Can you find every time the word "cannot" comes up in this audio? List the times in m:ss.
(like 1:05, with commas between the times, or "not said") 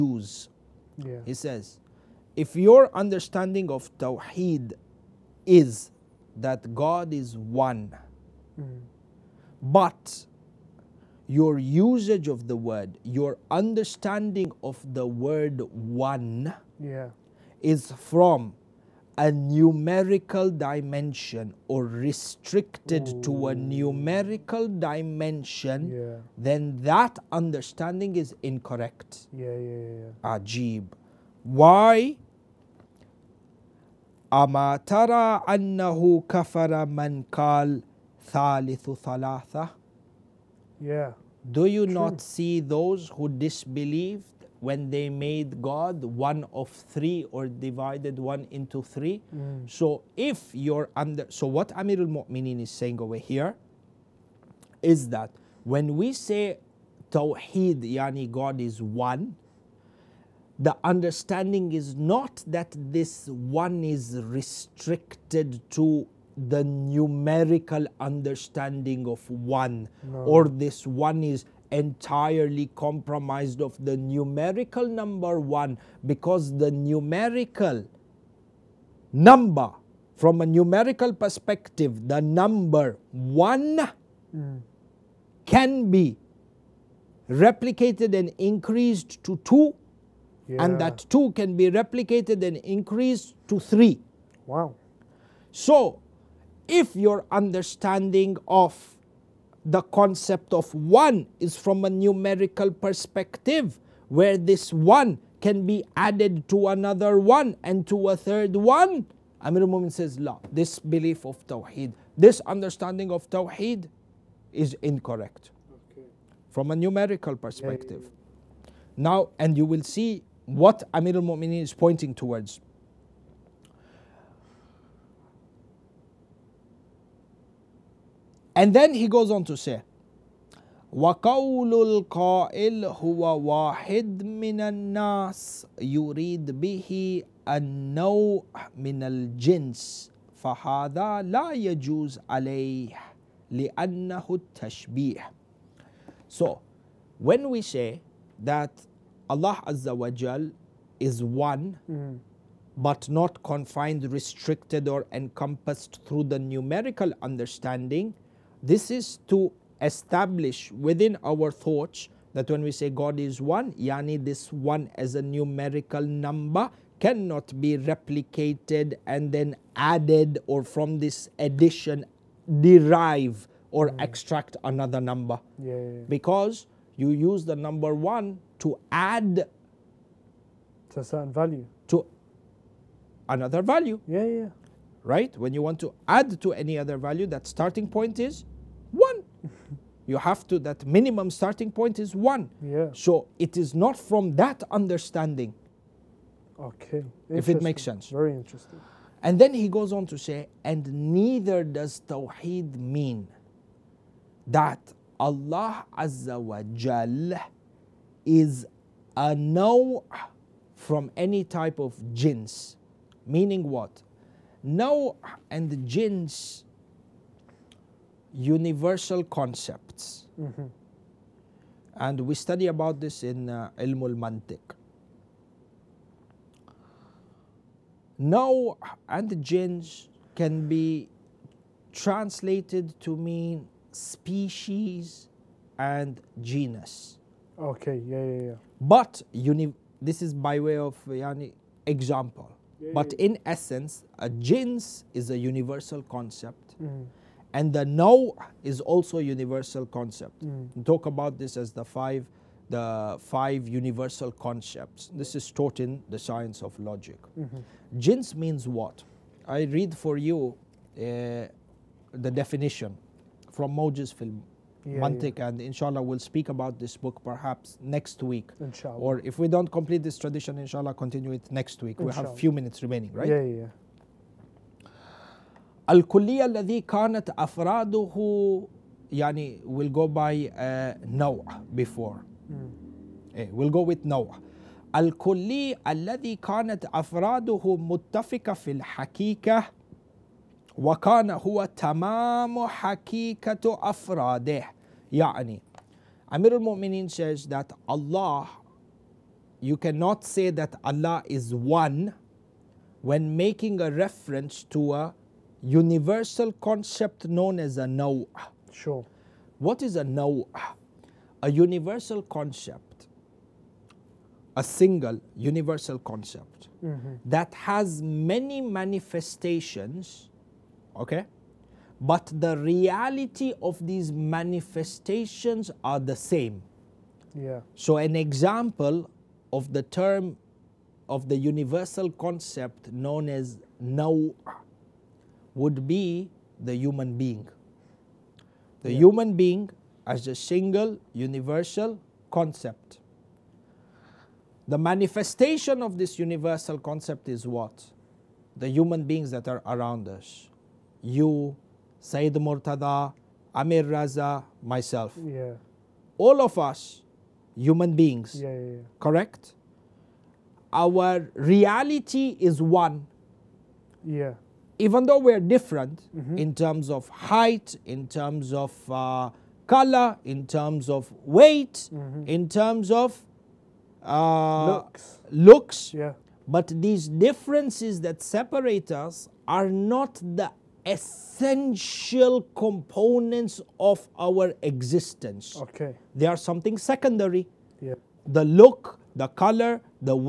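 2:46, 4:59.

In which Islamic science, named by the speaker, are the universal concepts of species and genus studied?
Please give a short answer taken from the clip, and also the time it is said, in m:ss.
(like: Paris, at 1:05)
Ilm al-Mantiq, at 3:43.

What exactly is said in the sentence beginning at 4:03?
in essence, a jins is a universal concept.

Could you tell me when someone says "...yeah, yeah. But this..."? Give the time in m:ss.
3:58.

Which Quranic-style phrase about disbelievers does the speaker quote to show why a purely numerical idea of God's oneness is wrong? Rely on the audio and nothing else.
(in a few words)
kafara man kal thalithu thalatha.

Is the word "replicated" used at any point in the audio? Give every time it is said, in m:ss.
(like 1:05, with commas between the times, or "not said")
1:27, 1:31, 2:47.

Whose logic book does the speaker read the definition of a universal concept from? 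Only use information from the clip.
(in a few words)
Moj's film.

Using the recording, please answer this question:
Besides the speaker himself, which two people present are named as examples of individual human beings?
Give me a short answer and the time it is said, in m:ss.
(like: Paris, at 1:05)
Sayyid Murtada, Amir Raza, at 5:51.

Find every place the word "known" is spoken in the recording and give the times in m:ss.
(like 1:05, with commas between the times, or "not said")
5:07, 5:32.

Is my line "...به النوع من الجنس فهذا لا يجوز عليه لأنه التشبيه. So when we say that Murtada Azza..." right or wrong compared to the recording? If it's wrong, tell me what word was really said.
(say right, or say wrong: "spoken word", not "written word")
wrong: "Allah", not "Murtada".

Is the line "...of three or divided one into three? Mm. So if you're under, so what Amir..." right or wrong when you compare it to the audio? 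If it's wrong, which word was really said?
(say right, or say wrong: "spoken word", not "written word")
right.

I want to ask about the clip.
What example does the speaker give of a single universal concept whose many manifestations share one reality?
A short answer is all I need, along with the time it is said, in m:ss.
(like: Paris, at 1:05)
The human being, at 5:36.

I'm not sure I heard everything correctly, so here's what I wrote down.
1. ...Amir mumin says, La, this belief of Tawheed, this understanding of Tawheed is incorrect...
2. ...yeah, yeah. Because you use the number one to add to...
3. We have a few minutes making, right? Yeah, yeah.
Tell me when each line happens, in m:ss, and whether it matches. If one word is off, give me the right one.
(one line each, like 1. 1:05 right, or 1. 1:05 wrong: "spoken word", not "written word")
1. 1:49 right
2. 2:55 right
3. 4:32 wrong: "remaining", not "making".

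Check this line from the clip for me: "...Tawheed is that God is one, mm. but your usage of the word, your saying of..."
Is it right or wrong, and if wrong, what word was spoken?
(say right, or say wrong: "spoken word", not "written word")
wrong: "understanding", not "saying".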